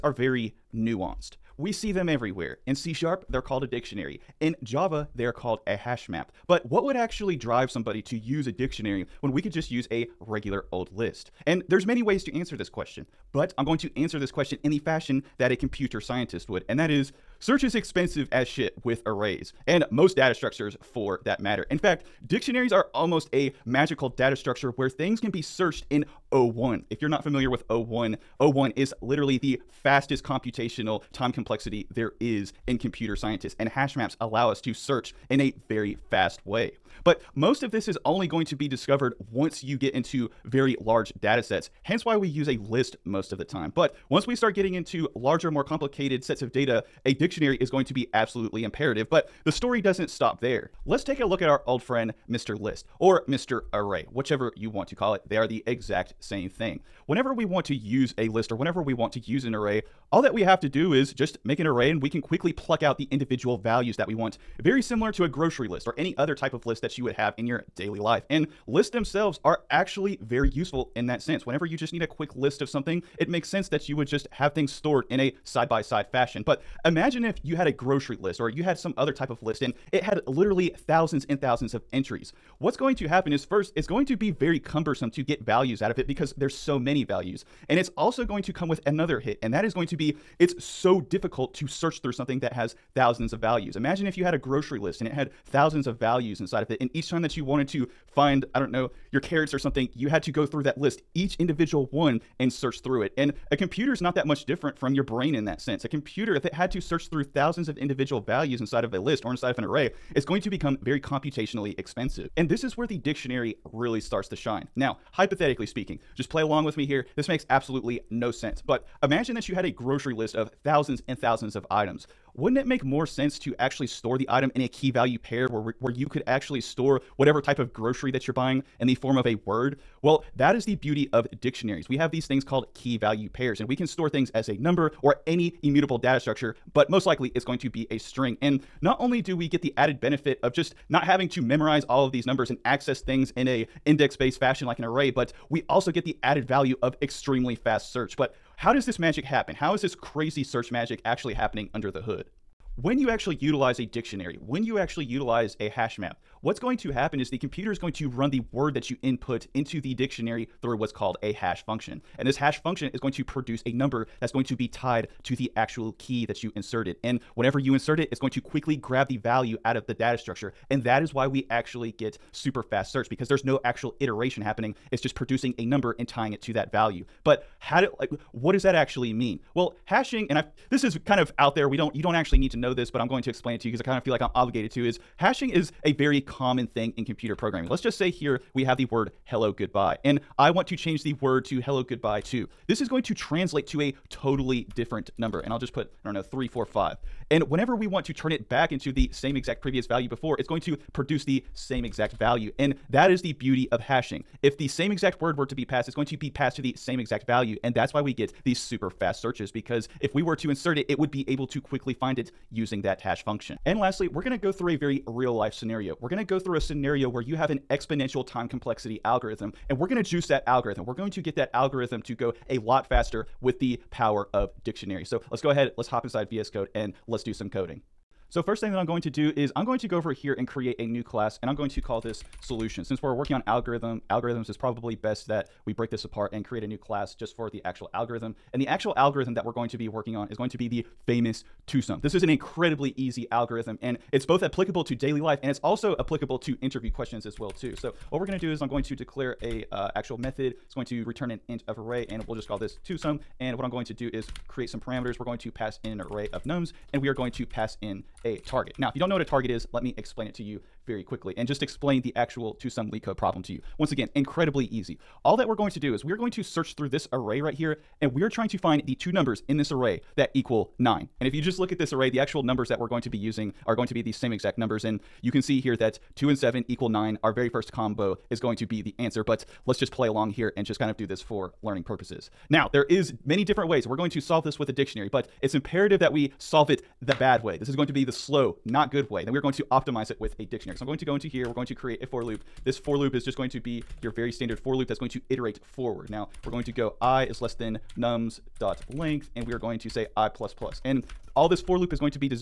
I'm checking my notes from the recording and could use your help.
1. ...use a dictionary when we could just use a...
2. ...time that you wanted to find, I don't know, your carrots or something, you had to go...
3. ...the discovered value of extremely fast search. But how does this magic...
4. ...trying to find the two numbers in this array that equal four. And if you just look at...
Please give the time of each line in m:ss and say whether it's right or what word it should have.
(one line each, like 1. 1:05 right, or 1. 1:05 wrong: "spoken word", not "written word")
1. 0:08 right
2. 1:37 right
3. 2:26 wrong: "added", not "discovered"
4. 4:28 wrong: "nine", not "four".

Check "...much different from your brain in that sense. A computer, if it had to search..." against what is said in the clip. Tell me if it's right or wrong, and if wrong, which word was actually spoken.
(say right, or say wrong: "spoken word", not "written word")
right.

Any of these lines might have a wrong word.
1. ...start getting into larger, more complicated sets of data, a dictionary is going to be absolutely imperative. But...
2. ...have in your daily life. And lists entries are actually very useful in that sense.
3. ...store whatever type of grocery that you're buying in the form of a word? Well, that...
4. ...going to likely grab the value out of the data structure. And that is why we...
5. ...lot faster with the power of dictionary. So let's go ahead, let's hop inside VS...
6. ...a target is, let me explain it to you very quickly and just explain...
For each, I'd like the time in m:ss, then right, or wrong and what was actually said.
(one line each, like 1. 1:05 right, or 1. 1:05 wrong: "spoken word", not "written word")
1. 0:44 right
2. 1:07 wrong: "themselves", not "entries"
3. 2:06 right
4. 2:48 wrong: "quickly", not "likely"
5. 3:42 right
6. 4:19 right.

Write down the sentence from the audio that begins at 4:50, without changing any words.
So I'm going to go into here.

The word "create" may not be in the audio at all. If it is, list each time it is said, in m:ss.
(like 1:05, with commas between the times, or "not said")
3:50, 3:56, 4:14, 4:51.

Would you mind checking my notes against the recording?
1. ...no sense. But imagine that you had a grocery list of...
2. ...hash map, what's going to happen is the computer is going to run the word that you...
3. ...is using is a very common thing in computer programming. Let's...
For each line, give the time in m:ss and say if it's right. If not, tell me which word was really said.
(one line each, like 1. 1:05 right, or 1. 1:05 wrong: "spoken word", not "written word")
1. 1:58 right
2. 2:35 right
3. 3:04 wrong: "hashing", not "using".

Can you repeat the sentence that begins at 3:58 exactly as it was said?
And the actual algorithm that we're going to be working on is going to be the famous TwoSum.